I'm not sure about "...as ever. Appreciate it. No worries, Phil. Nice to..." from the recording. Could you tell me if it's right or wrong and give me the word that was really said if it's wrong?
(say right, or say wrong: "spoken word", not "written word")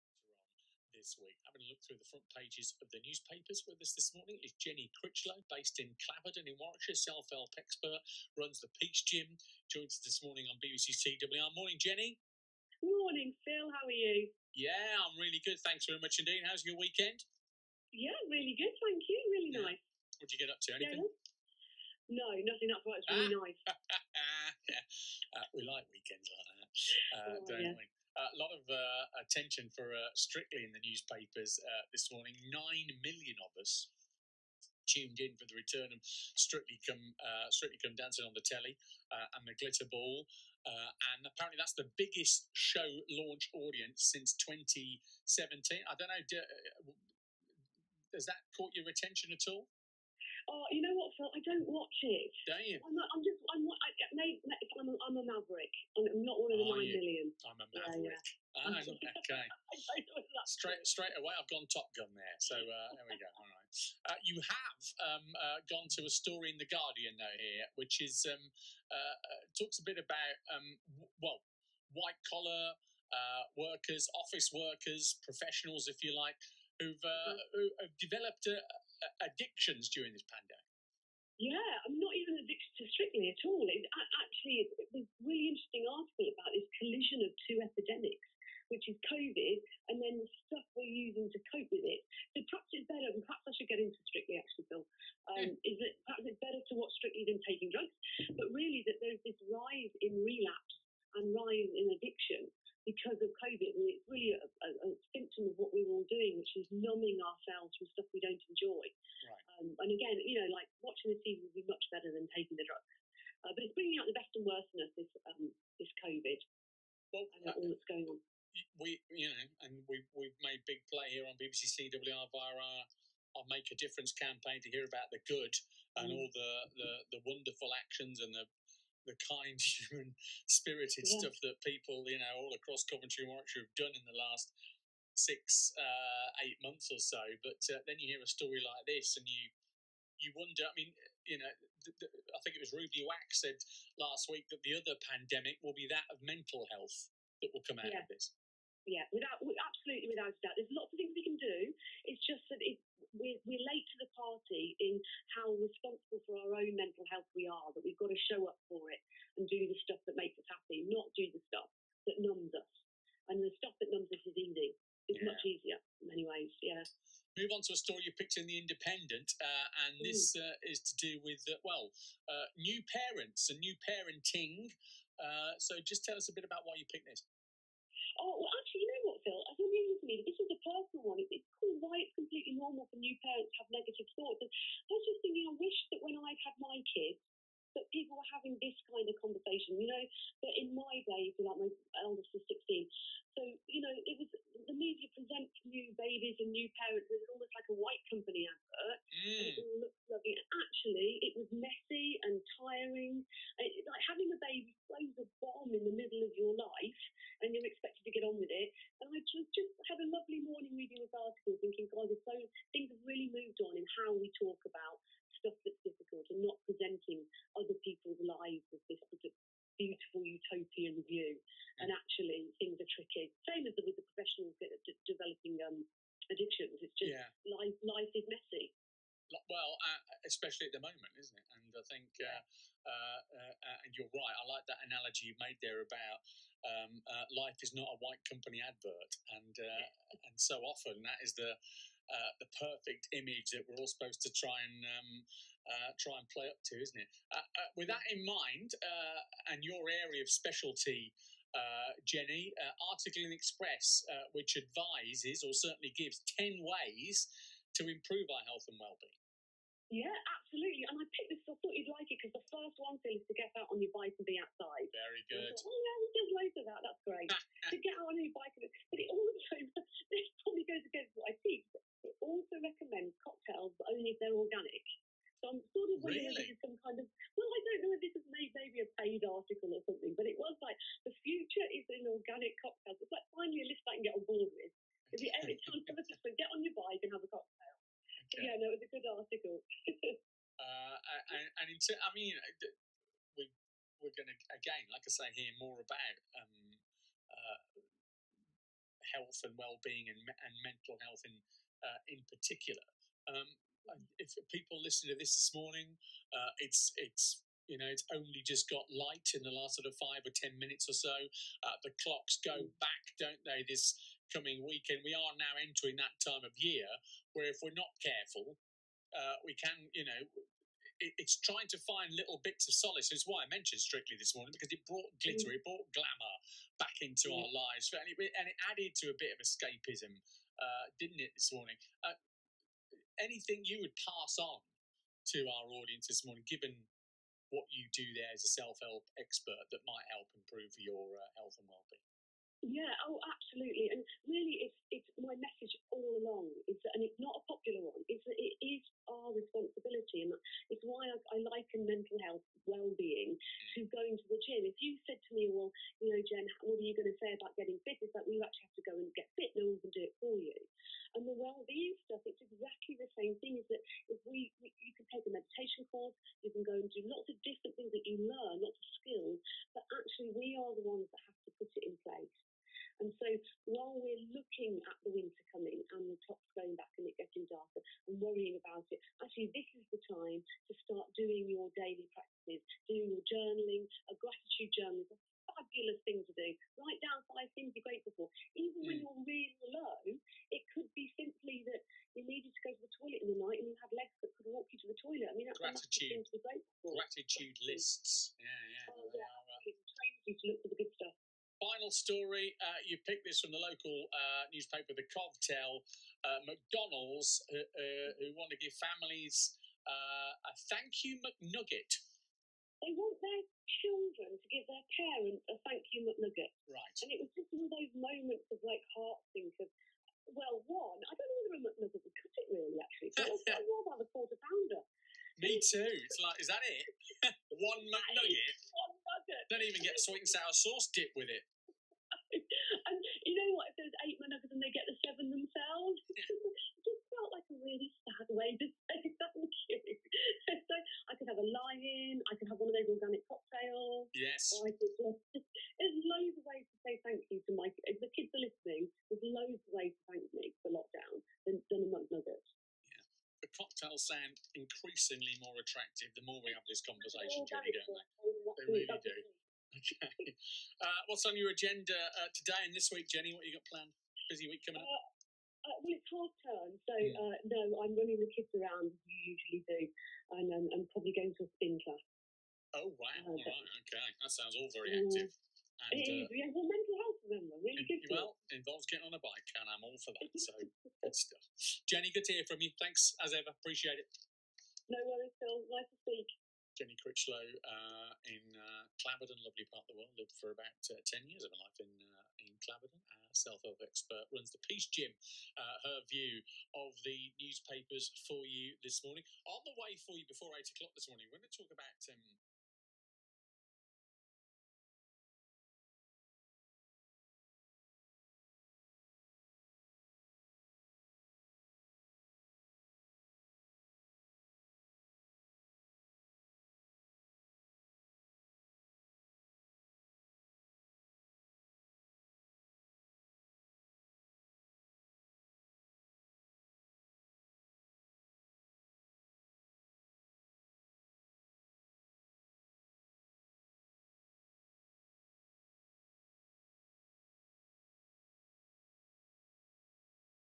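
right.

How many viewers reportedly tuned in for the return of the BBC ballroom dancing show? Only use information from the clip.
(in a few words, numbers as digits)
9 million.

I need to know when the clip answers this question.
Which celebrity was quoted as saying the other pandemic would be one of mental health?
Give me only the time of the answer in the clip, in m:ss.
2:22.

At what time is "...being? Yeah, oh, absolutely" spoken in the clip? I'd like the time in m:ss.
5:41.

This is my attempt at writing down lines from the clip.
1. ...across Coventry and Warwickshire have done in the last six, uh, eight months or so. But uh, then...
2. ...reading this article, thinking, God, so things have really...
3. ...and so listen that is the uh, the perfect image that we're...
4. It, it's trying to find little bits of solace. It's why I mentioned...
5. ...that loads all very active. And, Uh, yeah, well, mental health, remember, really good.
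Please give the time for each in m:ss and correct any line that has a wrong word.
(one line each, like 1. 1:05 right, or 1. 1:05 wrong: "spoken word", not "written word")
1. 2:12 right
2. 3:30 right
3. 4:00 wrong: "often", not "listen"
4. 5:20 right
5. 7:54 wrong: "sounds", not "loads".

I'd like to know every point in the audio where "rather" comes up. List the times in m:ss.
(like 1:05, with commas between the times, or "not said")
7:03.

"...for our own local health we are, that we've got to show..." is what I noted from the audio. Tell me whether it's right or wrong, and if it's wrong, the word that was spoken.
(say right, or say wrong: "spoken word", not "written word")
wrong: "mental", not "local".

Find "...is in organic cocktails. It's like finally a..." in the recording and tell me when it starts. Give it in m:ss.
4:41.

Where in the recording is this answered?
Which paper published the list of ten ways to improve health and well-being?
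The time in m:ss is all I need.
4:13.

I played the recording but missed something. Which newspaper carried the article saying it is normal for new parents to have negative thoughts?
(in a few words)
The Independent.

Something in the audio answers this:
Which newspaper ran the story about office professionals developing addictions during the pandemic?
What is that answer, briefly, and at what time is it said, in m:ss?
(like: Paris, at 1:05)
the Guardian, at 1:06.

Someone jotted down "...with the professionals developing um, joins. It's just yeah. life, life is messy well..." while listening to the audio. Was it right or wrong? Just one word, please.
wrong.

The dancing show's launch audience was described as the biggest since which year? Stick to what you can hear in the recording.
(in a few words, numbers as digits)
2017.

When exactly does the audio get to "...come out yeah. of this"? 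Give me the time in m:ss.
2:27.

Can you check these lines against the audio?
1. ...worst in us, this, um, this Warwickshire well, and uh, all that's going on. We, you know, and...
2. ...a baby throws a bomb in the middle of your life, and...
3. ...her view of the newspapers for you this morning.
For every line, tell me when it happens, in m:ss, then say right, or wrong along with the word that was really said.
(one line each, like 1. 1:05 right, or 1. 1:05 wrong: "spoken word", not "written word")
1. 1:54 wrong: "COVID", not "Warwickshire"
2. 3:24 right
3. 8:15 right.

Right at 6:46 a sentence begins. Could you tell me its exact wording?
Uh, McDonald's, uh, who want to give families uh, a thank you McNugget.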